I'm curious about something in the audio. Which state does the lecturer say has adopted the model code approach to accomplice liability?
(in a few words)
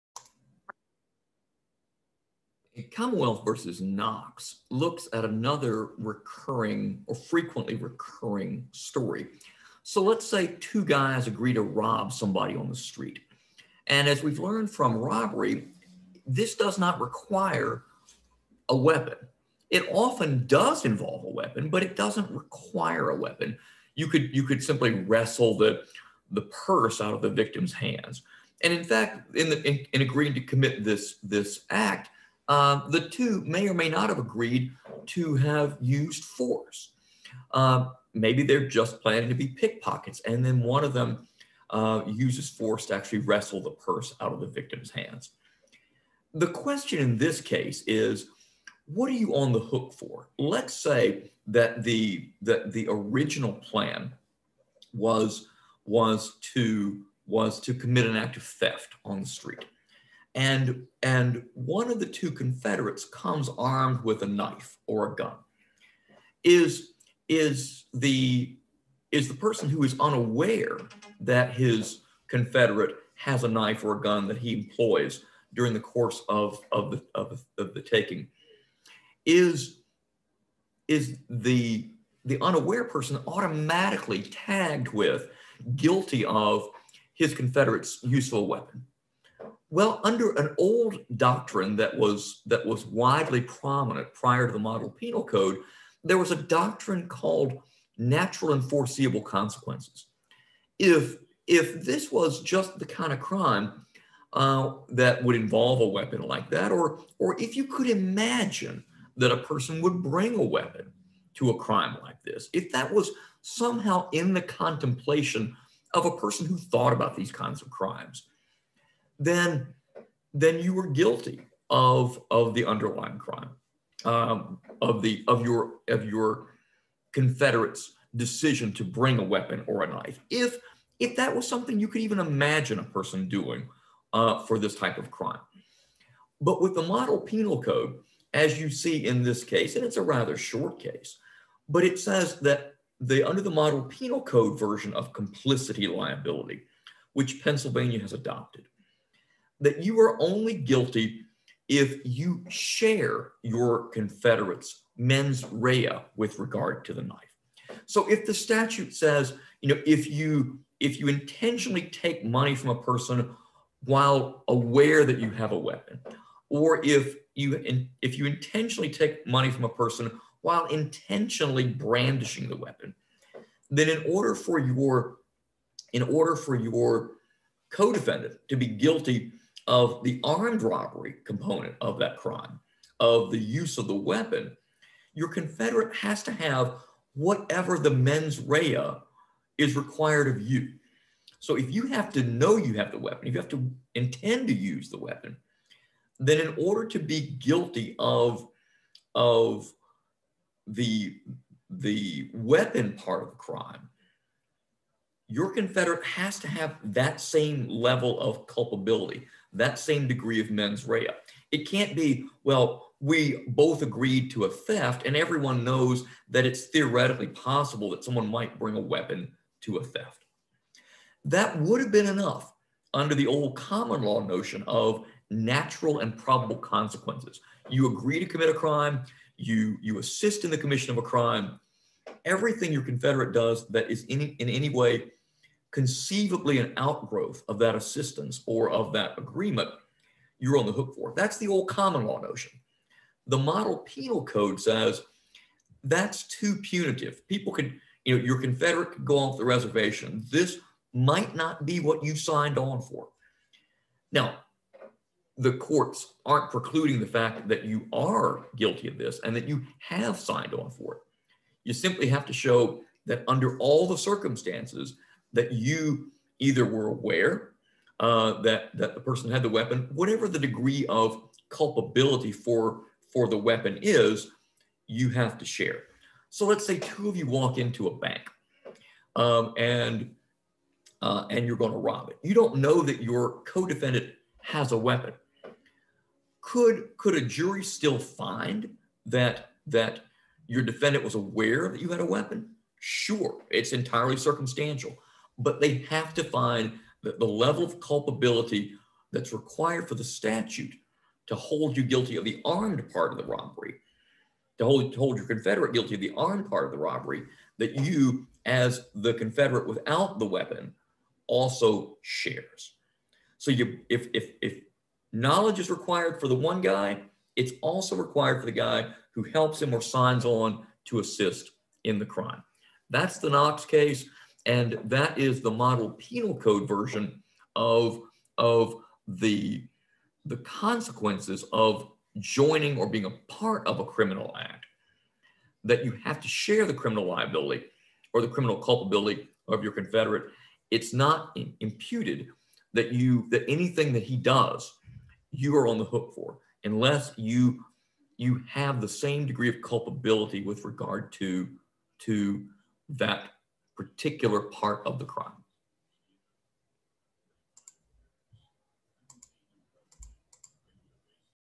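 Pennsylvania.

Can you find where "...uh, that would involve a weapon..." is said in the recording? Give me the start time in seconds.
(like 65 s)
104 s.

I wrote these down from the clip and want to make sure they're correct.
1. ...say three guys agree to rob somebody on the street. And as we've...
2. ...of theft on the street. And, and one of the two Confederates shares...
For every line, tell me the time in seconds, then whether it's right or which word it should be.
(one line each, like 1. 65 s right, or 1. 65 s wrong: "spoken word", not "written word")
1. 10 s wrong: "two", not "three"
2. 58 s wrong: "comes", not "shares".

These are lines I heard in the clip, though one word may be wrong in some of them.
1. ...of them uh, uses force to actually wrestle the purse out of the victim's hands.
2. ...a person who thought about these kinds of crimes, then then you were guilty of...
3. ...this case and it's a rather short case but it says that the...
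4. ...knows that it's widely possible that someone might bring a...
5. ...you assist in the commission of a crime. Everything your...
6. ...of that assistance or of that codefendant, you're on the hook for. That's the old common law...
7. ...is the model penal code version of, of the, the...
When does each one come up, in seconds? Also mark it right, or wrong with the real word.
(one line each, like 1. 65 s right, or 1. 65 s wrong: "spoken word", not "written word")
1. 40 s right
2. 116 s right
3. 139 s right
4. 215 s wrong: "theoretically", not "widely"
5. 229 s right
6. 237 s wrong: "agreement", not "codefendant"
7. 325 s right.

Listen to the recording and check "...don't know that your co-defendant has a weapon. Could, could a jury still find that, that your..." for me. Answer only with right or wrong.
right.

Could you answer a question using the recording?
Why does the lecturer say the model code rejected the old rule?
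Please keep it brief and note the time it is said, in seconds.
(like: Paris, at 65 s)
too punitive, at 246 s.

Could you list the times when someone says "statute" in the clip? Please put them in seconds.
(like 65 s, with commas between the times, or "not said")
158 s, 300 s.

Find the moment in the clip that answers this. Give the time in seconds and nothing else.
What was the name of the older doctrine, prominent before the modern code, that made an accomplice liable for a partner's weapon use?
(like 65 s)
97 s.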